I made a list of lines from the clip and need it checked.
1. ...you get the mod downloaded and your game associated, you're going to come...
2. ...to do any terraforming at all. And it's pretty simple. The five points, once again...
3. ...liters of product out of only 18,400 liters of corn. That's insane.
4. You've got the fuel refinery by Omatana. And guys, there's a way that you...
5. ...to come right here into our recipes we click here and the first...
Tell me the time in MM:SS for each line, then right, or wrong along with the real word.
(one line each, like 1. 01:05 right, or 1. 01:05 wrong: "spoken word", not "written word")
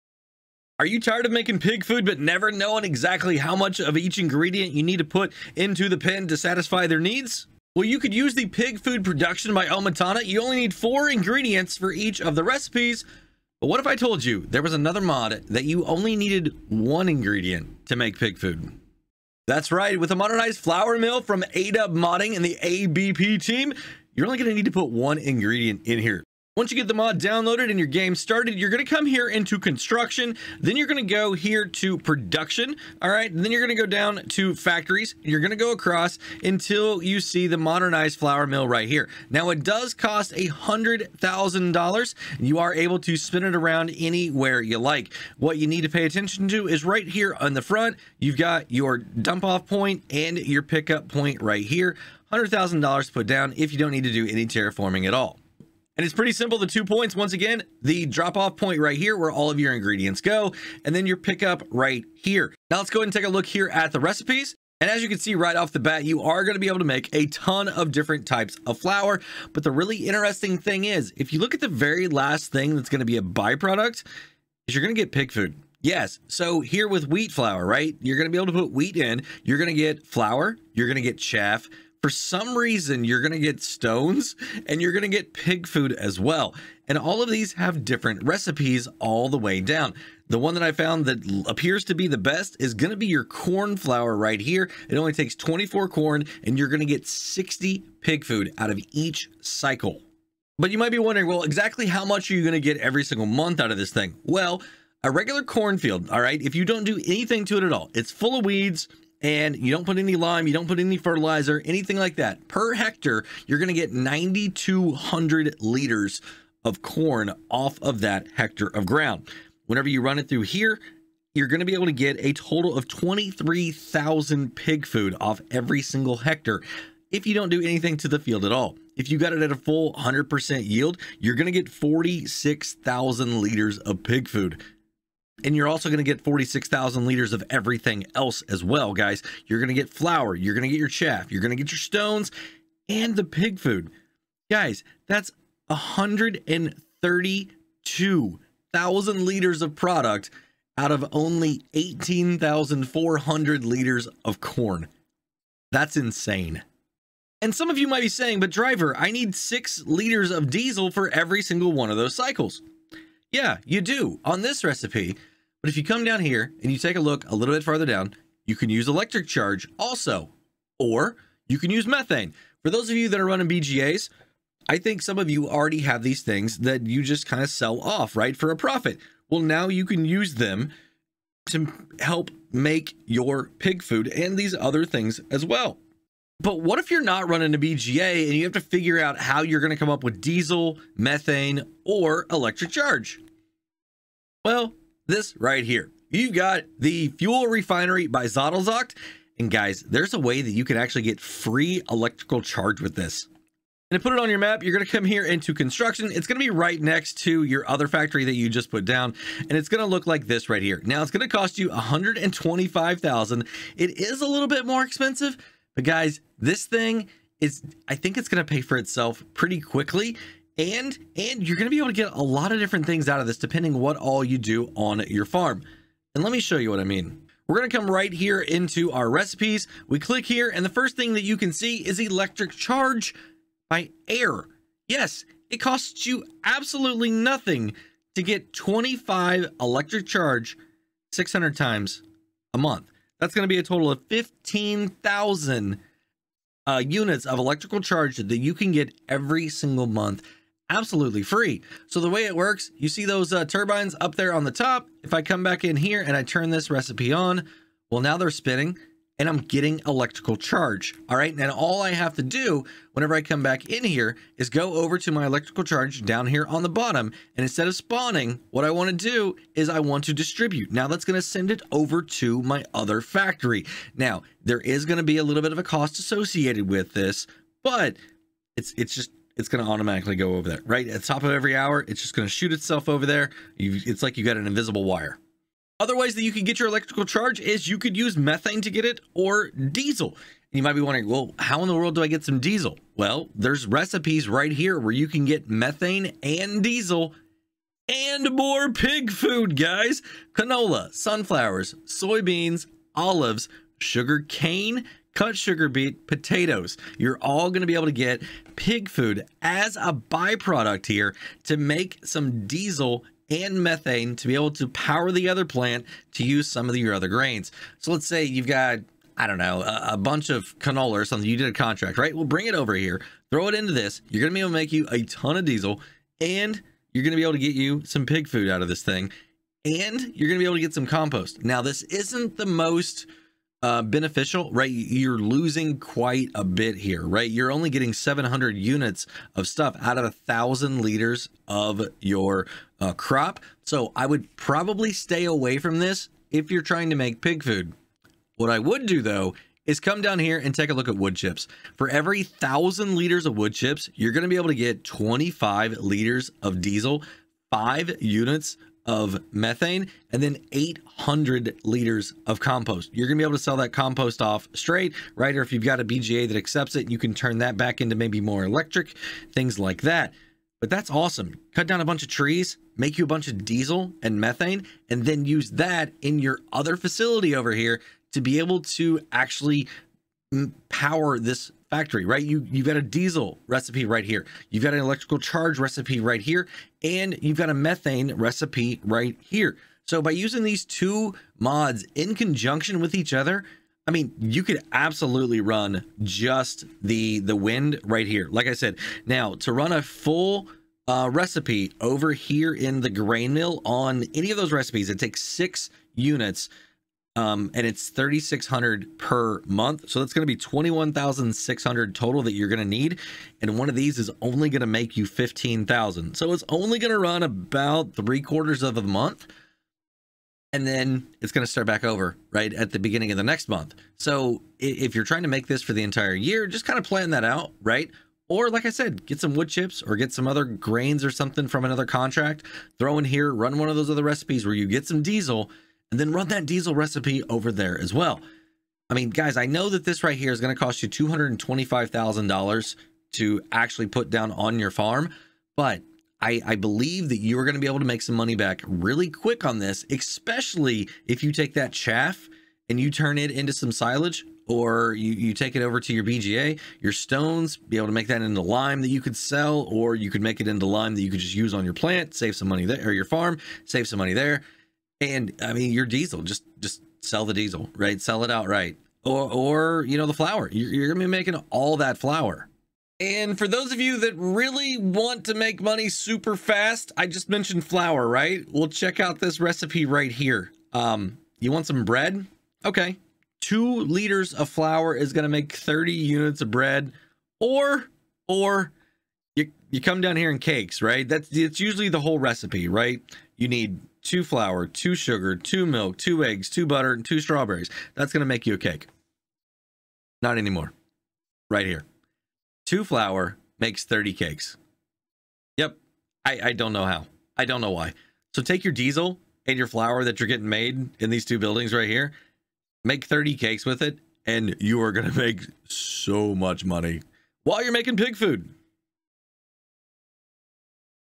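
1. 00:26 wrong: "started", not "associated"
2. 00:54 wrong: "two", not "five"
3. 02:29 right
4. 03:16 wrong: "Zodelzocht", not "Omatana"
5. 03:47 right.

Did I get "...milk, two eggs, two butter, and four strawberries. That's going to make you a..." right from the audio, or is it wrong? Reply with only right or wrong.
wrong.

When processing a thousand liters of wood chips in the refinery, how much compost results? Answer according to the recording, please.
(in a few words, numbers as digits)
800 liters.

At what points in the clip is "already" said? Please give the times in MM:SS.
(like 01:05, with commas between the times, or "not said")
02:55.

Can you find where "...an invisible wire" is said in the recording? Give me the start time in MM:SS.
04:44.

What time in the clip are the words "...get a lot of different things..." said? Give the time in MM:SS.
03:41.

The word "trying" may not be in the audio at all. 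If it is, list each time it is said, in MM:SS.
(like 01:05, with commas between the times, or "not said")
05:46, 07:05.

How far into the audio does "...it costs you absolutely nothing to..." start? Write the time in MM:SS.
03:55.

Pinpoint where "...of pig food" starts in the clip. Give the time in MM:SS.
02:13.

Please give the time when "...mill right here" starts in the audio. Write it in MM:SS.
00:38.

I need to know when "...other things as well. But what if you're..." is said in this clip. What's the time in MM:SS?
03:04.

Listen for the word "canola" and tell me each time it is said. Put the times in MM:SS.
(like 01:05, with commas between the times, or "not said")
05:00, 05:20.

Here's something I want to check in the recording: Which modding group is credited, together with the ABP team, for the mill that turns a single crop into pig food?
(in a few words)
ADUB Modding.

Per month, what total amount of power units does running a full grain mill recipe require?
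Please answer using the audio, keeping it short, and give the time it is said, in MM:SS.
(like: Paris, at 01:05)
21,600, at 06:50.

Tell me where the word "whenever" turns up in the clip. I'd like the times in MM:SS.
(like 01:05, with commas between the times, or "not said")
01:59, 04:22.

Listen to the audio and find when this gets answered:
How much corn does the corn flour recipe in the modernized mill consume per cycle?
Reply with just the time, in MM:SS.
01:35.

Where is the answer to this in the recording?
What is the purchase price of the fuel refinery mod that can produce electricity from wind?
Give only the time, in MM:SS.
03:31.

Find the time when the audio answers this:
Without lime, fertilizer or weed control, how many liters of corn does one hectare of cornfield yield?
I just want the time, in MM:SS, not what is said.
01:53.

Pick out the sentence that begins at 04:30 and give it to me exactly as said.
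Now that's going to send it over to my other factory.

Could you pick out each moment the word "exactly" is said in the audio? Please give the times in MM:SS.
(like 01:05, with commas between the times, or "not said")
00:02, 01:41.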